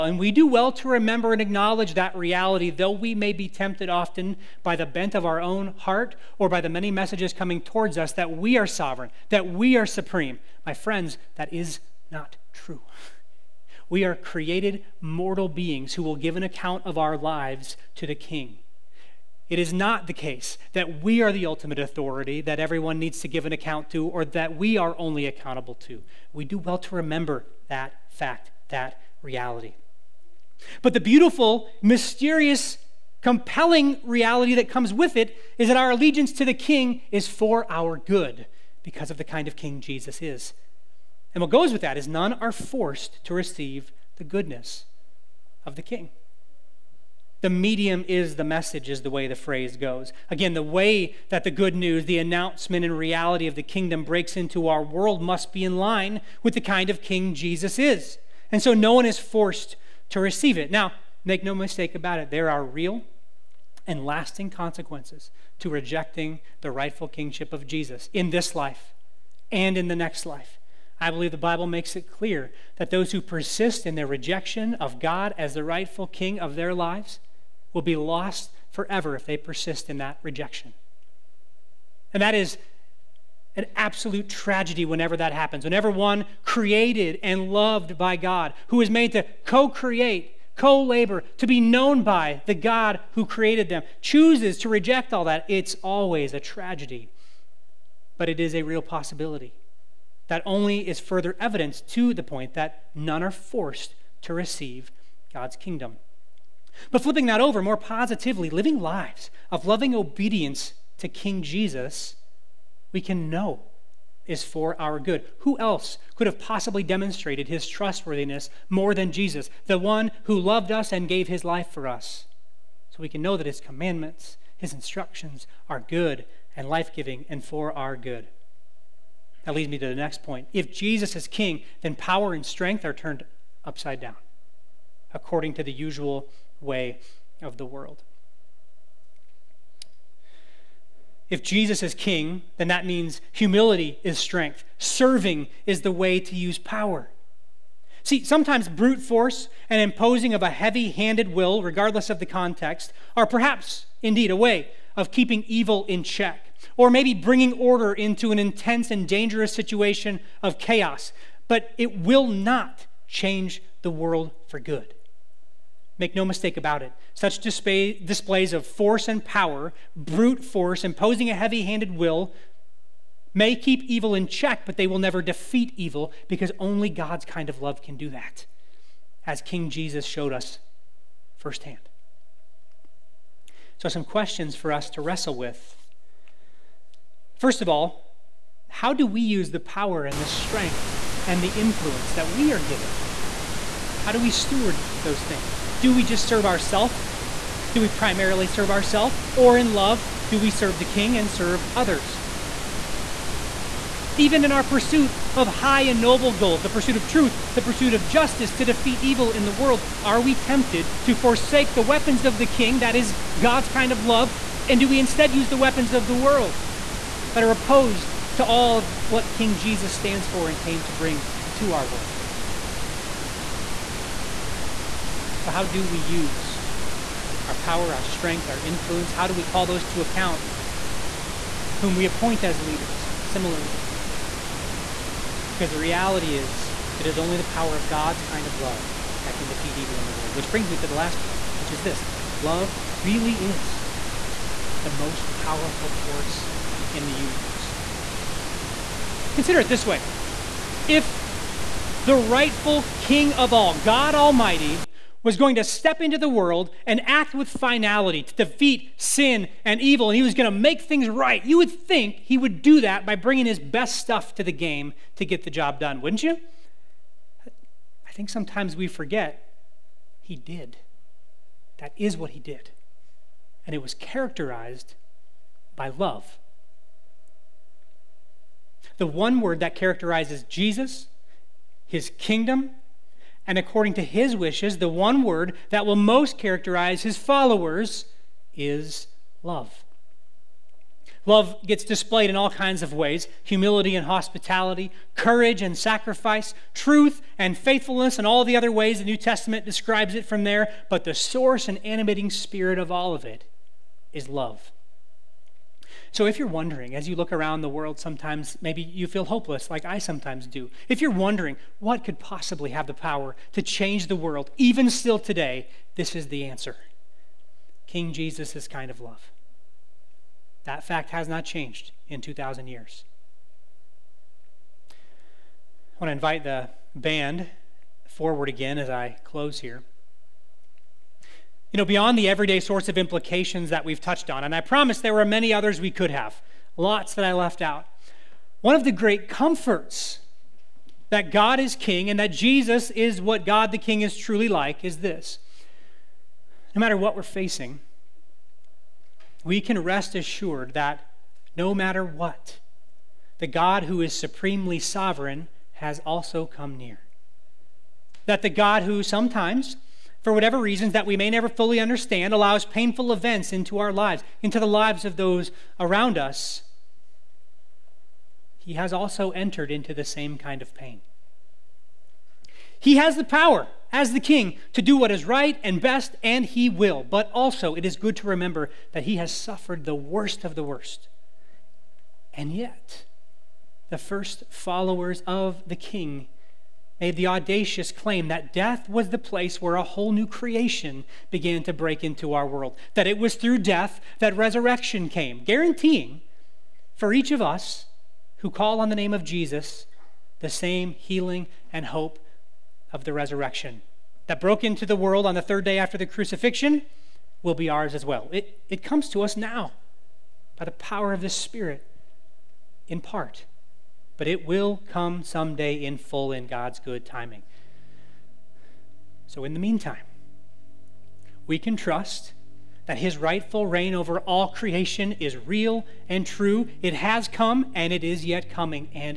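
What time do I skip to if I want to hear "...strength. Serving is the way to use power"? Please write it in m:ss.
2:24.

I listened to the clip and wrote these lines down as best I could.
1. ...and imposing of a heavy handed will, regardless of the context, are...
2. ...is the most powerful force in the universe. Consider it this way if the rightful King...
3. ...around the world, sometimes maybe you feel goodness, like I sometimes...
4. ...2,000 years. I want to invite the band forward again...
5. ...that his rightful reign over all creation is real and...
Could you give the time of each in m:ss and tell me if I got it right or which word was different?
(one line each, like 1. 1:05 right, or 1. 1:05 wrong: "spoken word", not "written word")
1. 2:29 right
2. 4:03 right
3. 5:07 wrong: "hopeless", not "goodness"
4. 5:22 right
5. 7:02 right.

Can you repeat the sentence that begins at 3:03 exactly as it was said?
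So, some questions for us to wrestle with.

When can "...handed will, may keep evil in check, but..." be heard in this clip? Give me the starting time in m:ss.
2:51.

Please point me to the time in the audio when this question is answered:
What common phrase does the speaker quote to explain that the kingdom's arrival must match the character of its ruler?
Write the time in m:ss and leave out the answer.
0:47.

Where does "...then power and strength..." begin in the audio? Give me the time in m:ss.
2:11.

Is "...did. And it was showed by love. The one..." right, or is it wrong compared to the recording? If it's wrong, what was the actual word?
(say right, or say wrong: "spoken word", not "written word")
wrong: "characterized", not "showed".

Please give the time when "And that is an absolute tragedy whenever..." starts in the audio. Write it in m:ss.
1:22.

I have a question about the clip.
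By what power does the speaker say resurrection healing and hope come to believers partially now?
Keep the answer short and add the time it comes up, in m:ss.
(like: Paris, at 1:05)
The Spirit, at 6:51.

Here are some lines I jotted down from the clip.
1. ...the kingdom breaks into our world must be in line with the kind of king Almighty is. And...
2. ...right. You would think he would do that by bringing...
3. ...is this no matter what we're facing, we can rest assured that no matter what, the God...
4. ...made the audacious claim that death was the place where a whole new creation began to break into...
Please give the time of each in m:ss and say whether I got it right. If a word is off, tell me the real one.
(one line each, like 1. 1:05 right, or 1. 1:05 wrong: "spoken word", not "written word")
1. 0:53 wrong: "Jesus", not "Almighty"
2. 4:21 right
3. 5:44 right
4. 6:27 right.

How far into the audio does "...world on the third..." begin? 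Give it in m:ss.
6:44.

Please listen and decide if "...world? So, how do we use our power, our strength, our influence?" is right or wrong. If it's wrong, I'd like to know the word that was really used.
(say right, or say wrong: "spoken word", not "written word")
right.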